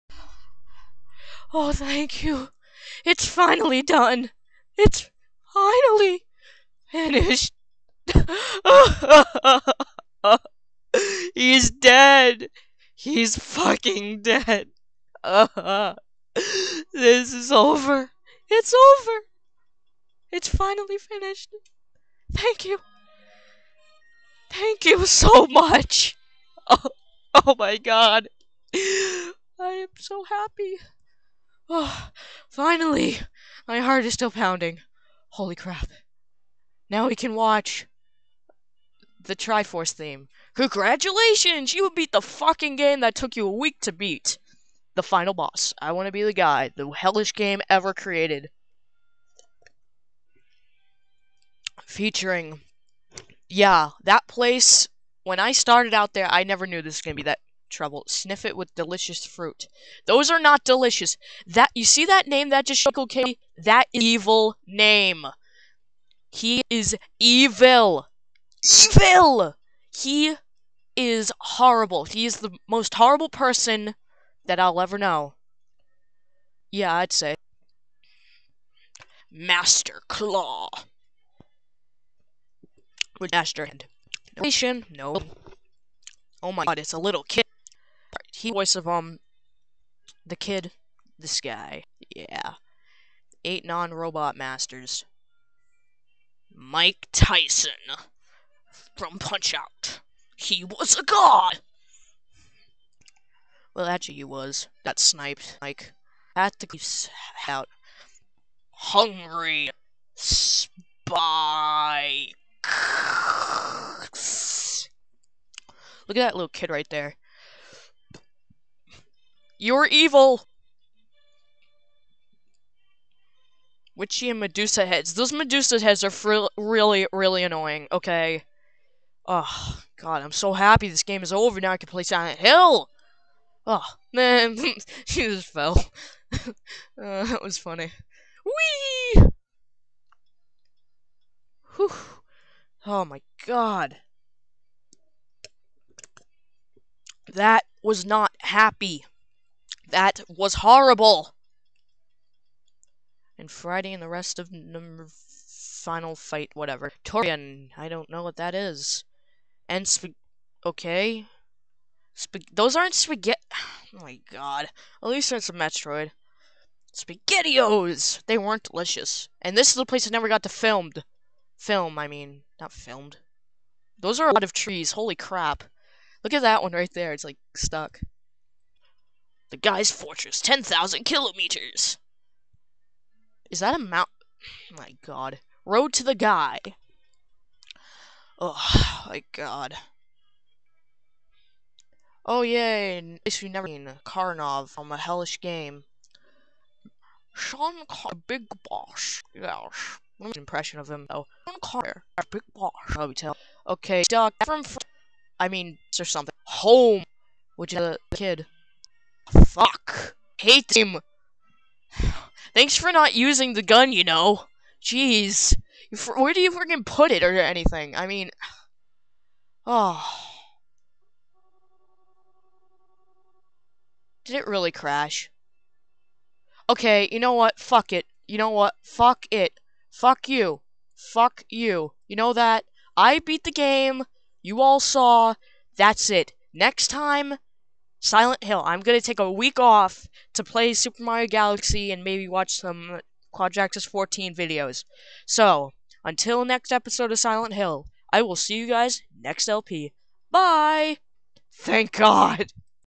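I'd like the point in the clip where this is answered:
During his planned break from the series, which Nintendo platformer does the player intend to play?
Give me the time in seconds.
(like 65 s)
240 s.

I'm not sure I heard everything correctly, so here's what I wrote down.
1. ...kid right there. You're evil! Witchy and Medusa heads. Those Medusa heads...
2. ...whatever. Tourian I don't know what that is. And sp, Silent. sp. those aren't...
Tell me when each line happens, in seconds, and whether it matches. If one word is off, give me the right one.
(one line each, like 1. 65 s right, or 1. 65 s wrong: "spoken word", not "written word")
1. 116 s right
2. 156 s wrong: "Okay", not "Silent".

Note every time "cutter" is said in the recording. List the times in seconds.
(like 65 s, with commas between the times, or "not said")
not said.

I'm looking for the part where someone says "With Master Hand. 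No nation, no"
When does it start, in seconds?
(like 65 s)
83 s.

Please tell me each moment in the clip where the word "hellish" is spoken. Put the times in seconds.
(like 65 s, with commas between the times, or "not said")
46 s, 194 s.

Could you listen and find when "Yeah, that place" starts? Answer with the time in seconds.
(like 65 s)
53 s.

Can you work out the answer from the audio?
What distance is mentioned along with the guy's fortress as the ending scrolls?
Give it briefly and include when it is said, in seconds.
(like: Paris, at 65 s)
10,000 kilometers, at 180 s.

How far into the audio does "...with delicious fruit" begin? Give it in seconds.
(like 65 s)
58 s.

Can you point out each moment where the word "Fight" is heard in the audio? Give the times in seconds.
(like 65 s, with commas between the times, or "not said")
156 s.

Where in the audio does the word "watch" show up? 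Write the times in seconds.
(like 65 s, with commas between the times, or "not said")
37 s, 242 s.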